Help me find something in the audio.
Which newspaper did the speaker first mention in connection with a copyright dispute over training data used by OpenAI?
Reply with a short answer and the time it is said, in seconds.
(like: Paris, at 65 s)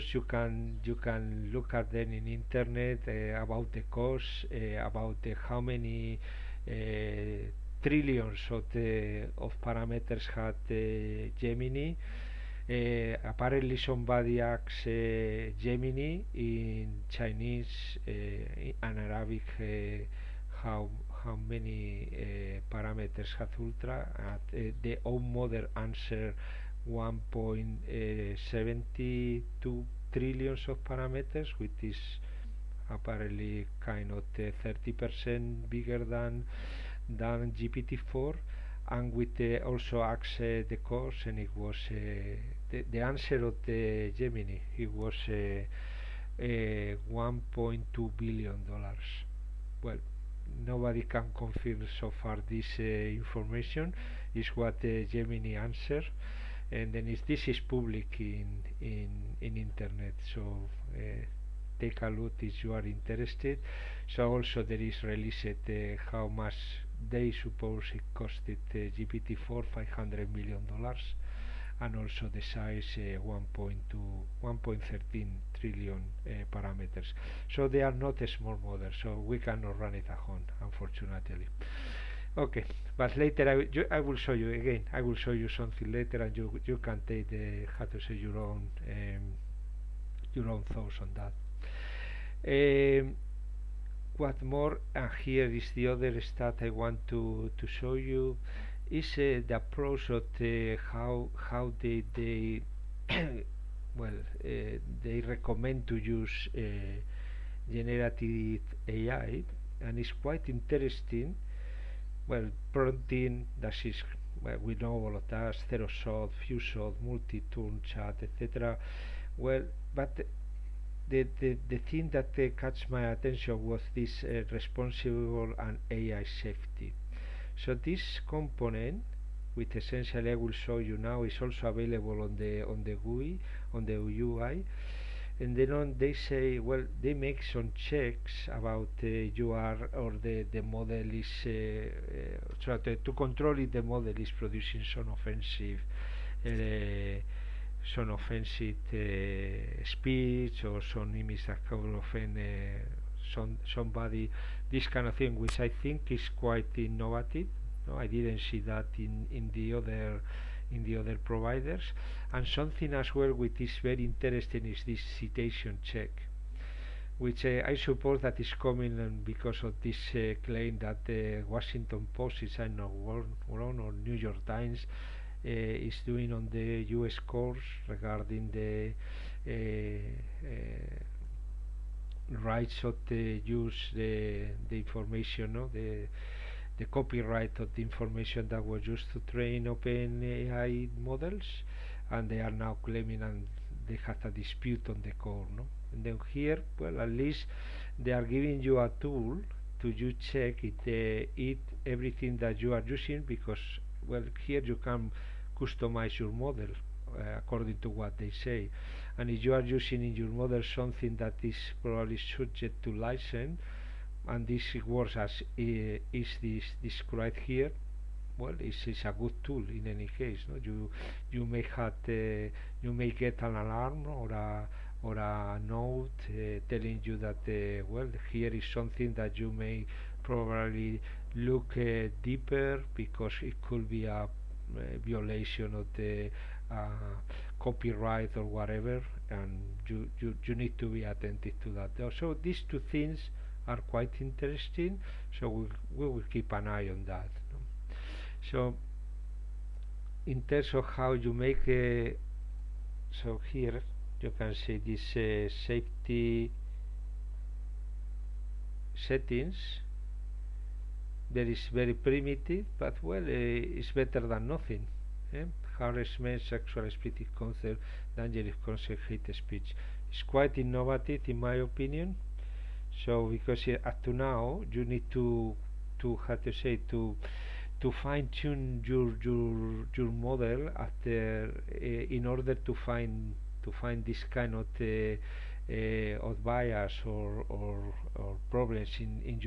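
Washington Post, at 171 s.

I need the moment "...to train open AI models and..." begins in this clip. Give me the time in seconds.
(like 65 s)
189 s.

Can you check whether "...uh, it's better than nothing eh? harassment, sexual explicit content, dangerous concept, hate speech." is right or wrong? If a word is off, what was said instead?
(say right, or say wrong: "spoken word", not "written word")
right.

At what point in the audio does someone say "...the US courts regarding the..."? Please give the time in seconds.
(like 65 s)
176 s.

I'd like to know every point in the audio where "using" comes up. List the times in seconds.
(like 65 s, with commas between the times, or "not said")
202 s, 209 s.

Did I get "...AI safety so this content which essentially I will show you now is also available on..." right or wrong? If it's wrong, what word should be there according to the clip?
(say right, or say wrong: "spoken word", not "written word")
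wrong: "component", not "content".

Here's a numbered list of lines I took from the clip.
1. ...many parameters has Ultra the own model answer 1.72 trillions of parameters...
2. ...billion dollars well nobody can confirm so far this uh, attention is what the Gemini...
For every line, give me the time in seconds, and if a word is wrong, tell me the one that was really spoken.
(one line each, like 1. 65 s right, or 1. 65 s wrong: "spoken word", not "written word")
1. 21 s right
2. 48 s wrong: "information", not "attention".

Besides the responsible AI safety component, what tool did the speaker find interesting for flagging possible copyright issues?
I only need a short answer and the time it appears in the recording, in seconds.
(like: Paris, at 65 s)
citation check, at 165 s.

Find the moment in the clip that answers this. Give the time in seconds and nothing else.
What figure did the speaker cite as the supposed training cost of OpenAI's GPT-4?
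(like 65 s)
69 s.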